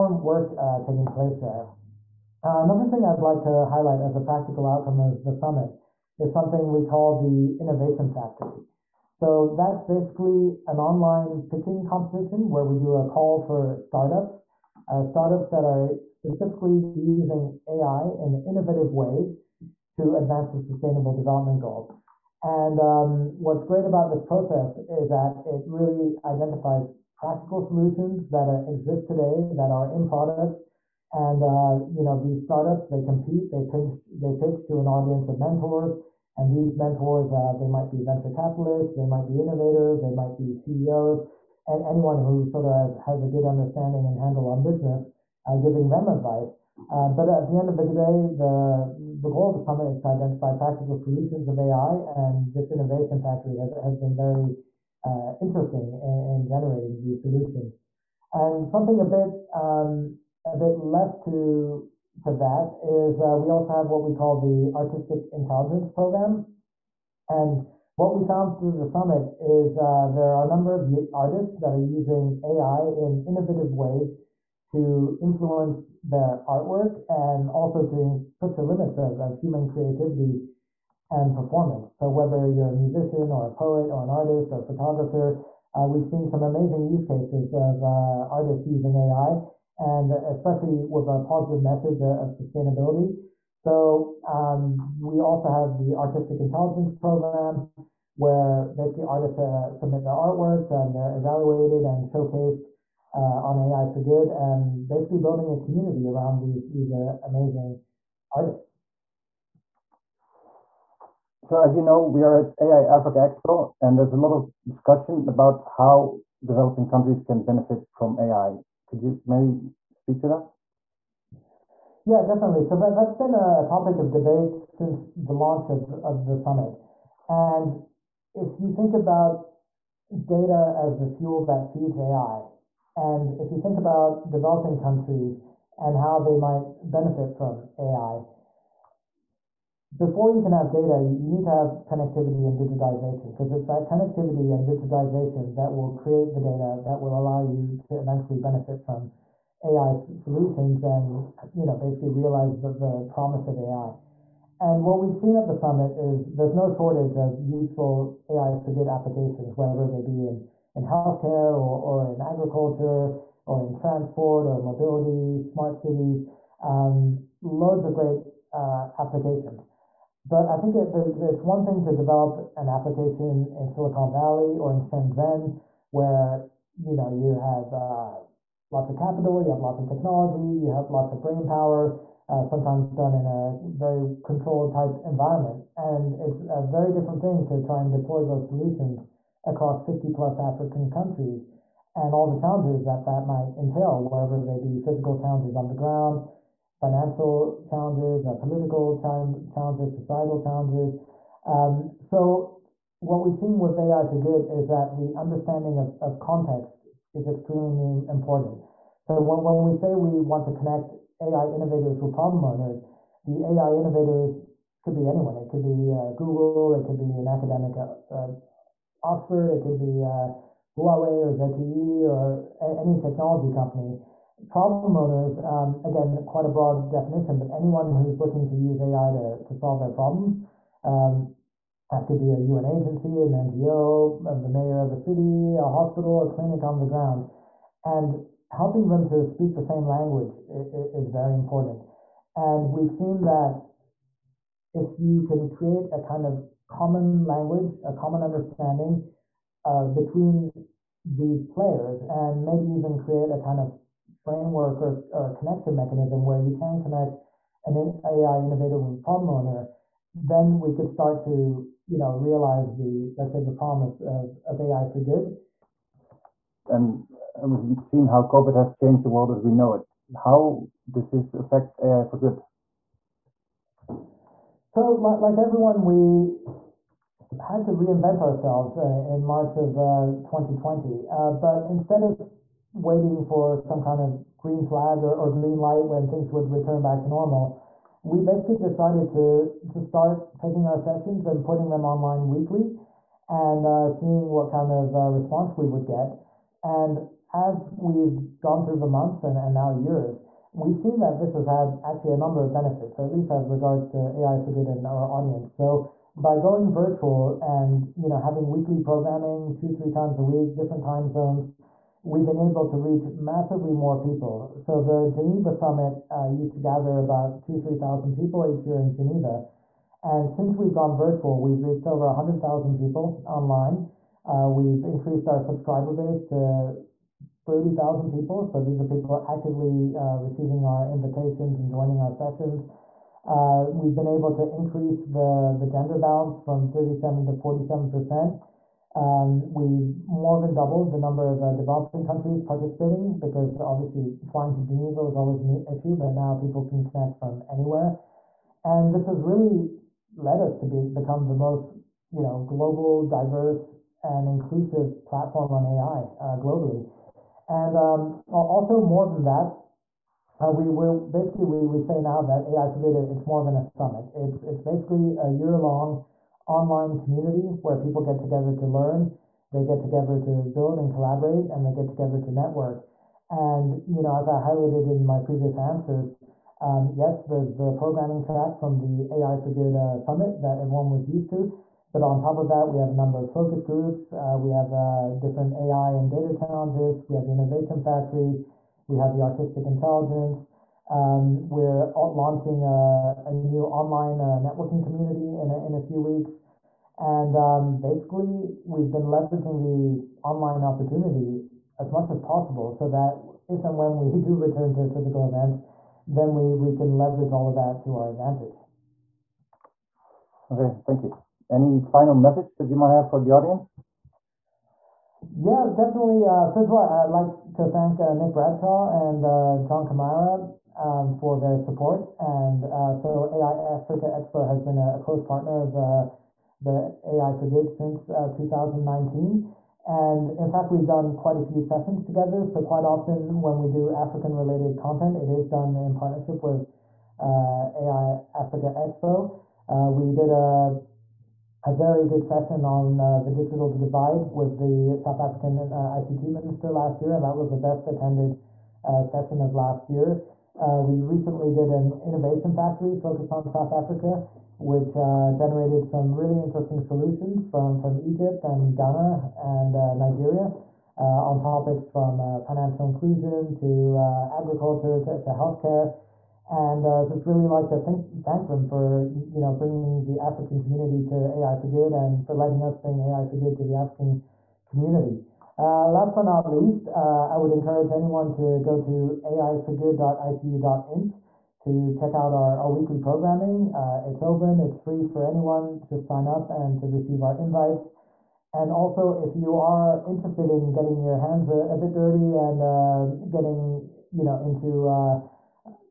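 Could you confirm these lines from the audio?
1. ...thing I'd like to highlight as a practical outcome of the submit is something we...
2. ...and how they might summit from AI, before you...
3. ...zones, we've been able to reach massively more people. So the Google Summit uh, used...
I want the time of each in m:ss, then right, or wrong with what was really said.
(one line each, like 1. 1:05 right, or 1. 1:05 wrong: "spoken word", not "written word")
1. 0:02 wrong: "summit", not "submit"
2. 2:15 wrong: "benefit", not "summit"
3. 5:11 wrong: "Geneva", not "Google".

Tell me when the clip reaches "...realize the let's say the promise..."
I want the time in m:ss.
4:22.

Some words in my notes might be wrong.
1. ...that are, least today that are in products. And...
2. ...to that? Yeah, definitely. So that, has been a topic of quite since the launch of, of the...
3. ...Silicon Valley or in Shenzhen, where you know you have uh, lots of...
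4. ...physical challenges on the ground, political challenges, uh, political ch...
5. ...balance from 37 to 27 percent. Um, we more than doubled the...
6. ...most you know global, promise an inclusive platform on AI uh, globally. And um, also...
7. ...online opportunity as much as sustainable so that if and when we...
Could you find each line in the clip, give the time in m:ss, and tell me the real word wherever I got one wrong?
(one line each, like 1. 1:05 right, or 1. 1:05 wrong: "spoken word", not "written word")
1. 0:28 wrong: "exist", not "least"
2. 2:00 wrong: "debate", not "quite"
3. 2:53 right
4. 3:14 wrong: "financial", not "political"
5. 5:35 wrong: "47", not "27"
6. 5:51 wrong: "diverse", not "promise"
7. 6:40 wrong: "possible", not "sustainable".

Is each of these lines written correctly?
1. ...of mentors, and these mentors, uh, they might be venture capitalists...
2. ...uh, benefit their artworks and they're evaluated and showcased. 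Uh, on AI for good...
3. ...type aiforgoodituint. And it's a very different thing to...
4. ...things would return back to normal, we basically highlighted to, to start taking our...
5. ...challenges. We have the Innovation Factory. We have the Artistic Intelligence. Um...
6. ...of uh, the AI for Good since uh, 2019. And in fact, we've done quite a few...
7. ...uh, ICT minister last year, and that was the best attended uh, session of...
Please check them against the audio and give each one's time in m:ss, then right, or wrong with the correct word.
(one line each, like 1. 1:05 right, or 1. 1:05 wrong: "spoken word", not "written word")
1. 0:35 right
2. 1:39 wrong: "submit", not "benefit"
3. 3:04 wrong: "environment", not "aiforgoodituint"
4. 4:46 wrong: "decided", not "highlighted"
5. 6:26 right
6. 7:05 right
7. 7:25 right.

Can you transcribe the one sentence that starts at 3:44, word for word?
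Problem owners, um, again, quite a broad definition, but anyone who's looking to use AI to, to solve their problems.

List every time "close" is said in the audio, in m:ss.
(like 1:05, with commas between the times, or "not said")
7:05.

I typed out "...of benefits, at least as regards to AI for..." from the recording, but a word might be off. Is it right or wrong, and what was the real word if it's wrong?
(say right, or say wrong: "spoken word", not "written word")
right.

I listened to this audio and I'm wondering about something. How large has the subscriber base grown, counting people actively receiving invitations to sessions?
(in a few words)
30,000.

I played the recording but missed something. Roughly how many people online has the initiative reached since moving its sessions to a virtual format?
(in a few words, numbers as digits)
over 100,000.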